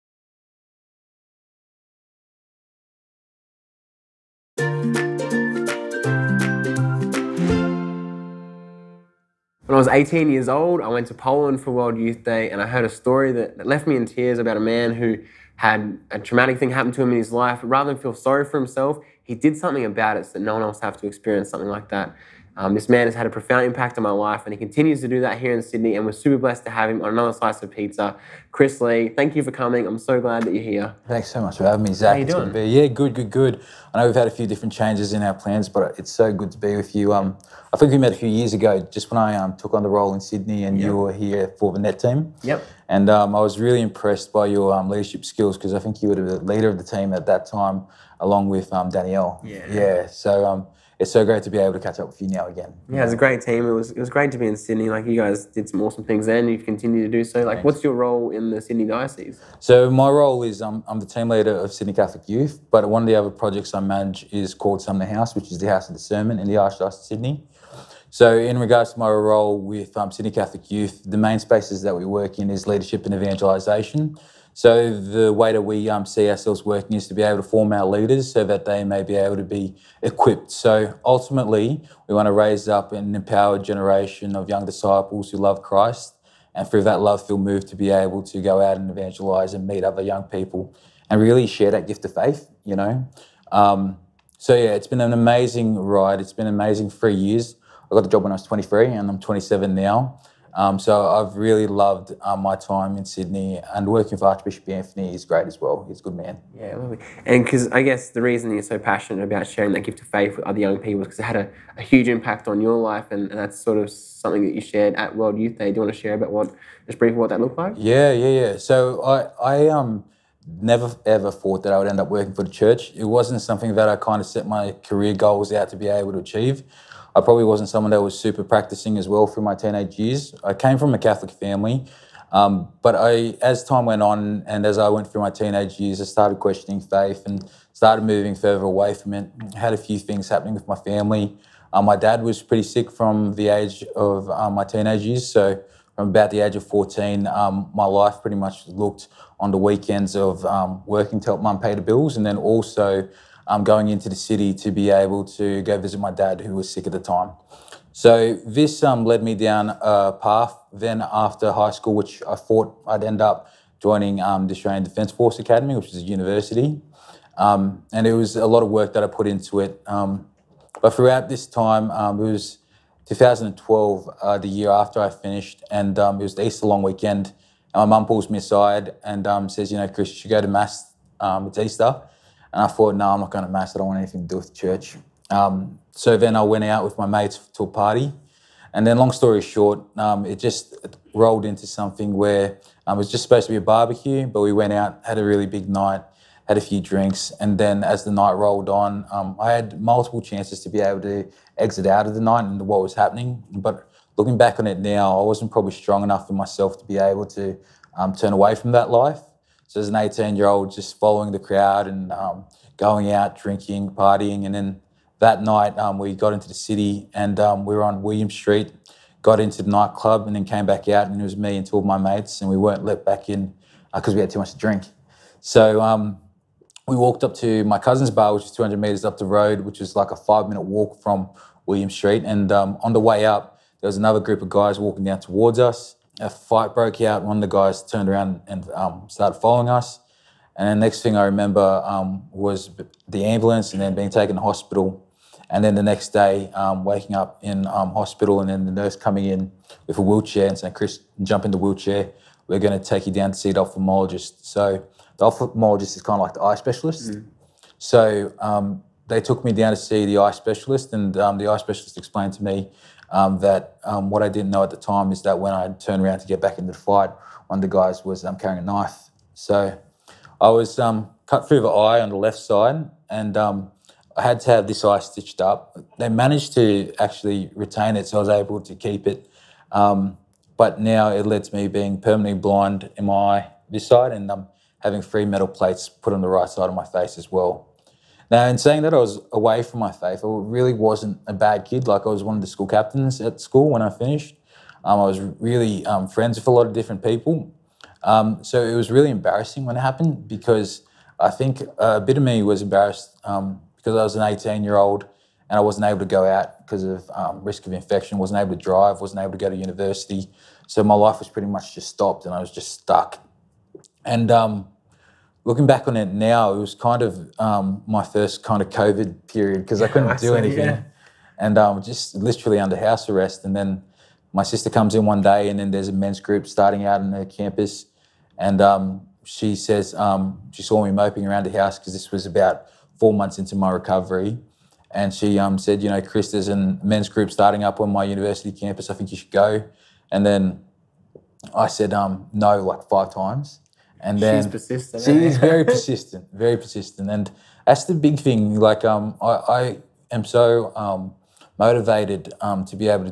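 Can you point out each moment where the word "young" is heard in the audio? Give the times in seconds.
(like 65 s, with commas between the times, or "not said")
84 s, 90 s, 110 s.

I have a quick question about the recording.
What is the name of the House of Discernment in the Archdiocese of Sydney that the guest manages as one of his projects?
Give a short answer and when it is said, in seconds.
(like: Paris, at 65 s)
Sumner House, at 64 s.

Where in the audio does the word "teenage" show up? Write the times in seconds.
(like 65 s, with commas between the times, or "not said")
129 s, 135 s, 144 s.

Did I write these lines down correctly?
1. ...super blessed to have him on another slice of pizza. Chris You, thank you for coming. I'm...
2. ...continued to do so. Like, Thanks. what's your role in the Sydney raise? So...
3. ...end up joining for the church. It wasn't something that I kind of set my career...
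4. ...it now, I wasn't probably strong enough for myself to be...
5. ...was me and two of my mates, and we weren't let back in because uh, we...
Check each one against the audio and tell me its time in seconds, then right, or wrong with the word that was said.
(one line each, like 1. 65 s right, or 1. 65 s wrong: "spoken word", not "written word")
1. 26 s wrong: "Lee", not "You"
2. 56 s wrong: "diocese", not "raise"
3. 121 s wrong: "working", not "joining"
4. 204 s right
5. 221 s right.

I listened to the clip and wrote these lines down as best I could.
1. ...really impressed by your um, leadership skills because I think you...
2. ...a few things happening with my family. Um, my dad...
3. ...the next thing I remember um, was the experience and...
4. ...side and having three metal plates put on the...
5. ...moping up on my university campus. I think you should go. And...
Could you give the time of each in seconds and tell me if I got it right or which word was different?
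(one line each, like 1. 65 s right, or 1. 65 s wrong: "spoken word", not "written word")
1. 43 s right
2. 139 s right
3. 240 s wrong: "ambulance", not "experience"
4. 283 s right
5. 337 s wrong: "starting", not "moping".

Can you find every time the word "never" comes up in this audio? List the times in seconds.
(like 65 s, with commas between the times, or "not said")
120 s.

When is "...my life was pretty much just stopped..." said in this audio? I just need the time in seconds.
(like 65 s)
310 s.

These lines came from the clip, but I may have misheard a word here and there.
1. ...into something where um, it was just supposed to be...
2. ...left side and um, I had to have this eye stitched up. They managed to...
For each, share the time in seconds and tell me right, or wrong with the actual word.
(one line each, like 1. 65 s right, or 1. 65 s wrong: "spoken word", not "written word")
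1. 191 s right
2. 272 s right.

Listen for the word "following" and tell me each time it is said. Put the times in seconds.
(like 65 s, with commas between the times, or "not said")
210 s, 239 s.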